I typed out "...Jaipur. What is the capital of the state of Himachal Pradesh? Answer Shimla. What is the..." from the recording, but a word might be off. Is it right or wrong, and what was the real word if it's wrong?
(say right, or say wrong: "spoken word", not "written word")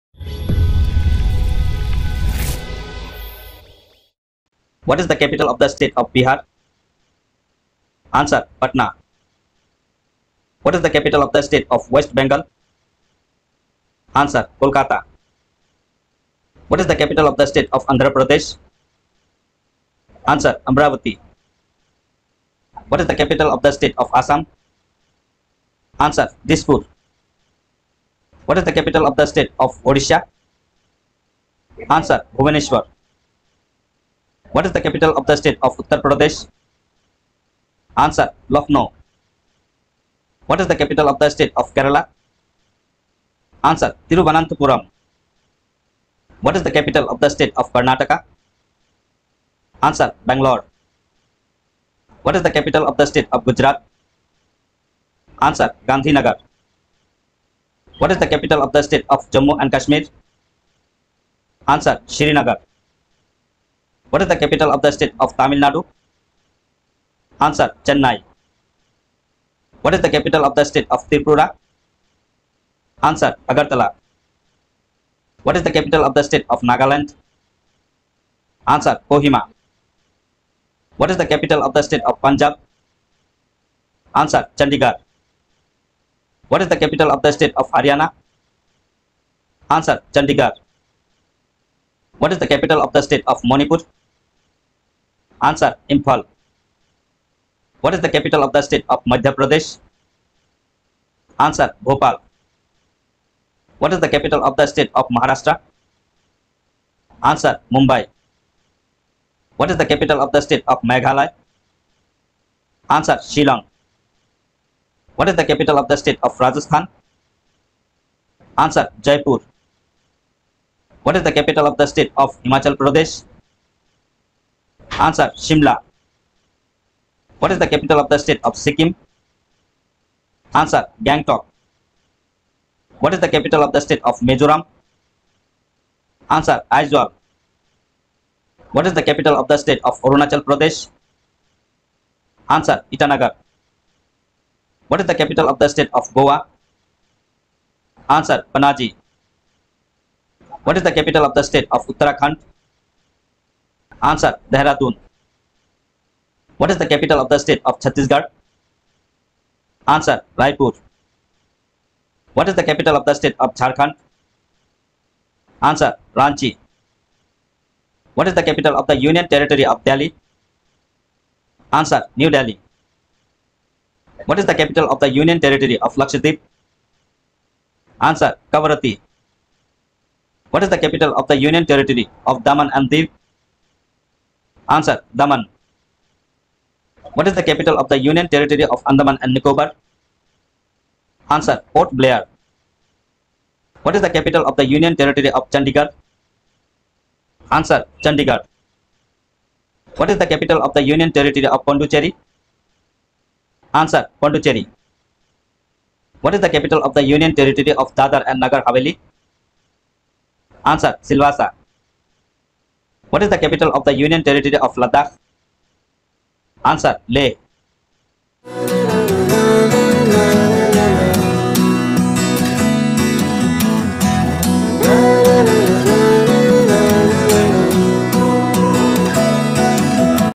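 right.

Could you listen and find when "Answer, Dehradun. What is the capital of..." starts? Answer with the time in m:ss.
2:34.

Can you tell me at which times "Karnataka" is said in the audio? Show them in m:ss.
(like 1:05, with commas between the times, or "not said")
0:47.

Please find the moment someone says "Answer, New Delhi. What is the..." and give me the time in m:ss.
2:51.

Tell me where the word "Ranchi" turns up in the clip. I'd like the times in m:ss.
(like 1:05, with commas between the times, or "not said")
2:46.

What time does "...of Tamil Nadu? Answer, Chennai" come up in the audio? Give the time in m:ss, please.
1:05.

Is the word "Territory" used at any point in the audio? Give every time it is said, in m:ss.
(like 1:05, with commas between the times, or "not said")
2:49, 2:55, 3:01, 3:08, 3:14, 3:21, 3:27, 3:34.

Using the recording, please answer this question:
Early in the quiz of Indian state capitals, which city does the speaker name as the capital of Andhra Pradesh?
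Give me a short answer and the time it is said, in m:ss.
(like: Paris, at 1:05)
Amravati, at 0:20.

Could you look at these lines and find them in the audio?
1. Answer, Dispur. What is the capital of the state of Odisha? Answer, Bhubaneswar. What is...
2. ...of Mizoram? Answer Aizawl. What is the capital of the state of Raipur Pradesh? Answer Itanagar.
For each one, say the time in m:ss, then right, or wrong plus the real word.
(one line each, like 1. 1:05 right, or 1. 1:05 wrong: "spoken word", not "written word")
1. 0:25 right
2. 2:14 wrong: "Arunachal", not "Raipur".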